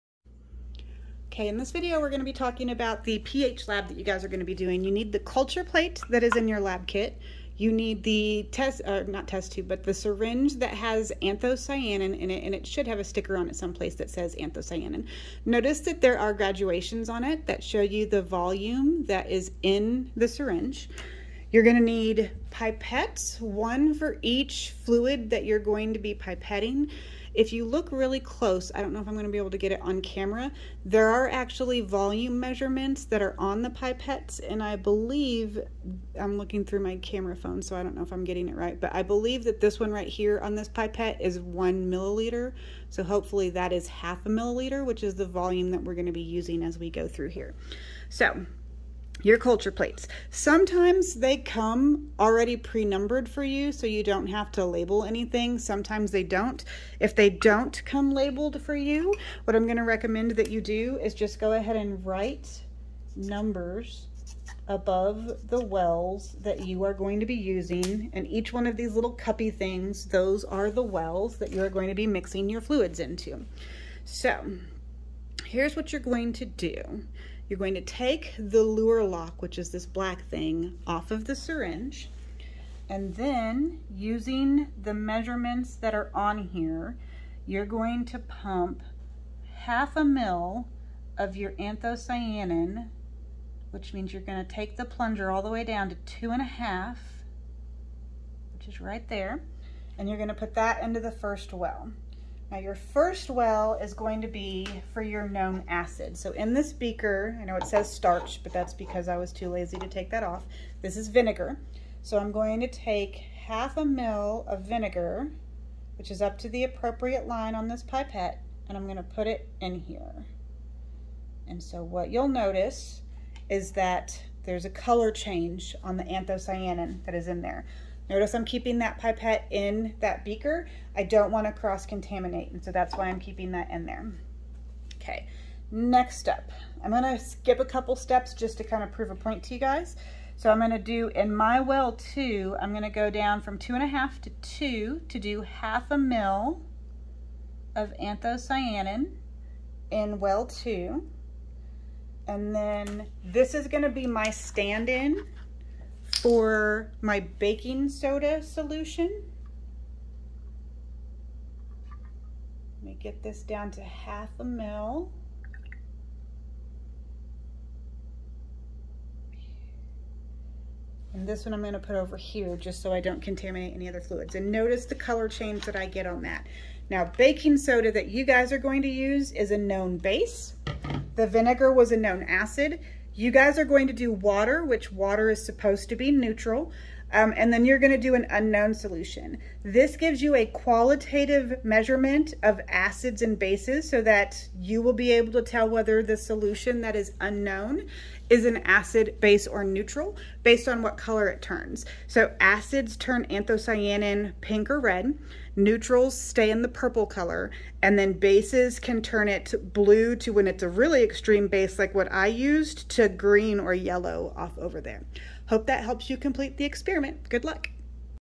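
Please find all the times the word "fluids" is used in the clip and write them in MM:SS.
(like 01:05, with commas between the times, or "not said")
00:24, 01:12, 02:53.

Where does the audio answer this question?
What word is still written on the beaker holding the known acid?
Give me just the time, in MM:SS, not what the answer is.
01:47.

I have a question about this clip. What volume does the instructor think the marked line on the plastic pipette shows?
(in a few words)
1 milliliter.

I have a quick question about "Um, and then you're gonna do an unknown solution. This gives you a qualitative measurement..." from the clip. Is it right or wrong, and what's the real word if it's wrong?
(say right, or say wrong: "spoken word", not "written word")
right.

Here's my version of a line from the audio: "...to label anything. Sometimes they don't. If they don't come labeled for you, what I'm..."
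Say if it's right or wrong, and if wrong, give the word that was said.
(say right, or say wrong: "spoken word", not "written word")
right.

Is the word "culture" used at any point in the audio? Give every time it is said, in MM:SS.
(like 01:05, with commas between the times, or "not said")
00:05, 00:49.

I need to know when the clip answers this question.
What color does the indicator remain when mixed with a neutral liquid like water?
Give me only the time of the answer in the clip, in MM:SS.
03:26.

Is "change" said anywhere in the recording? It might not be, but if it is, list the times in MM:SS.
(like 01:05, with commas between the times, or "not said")
02:05, 02:55.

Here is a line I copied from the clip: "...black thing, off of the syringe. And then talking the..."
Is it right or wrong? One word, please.
wrong.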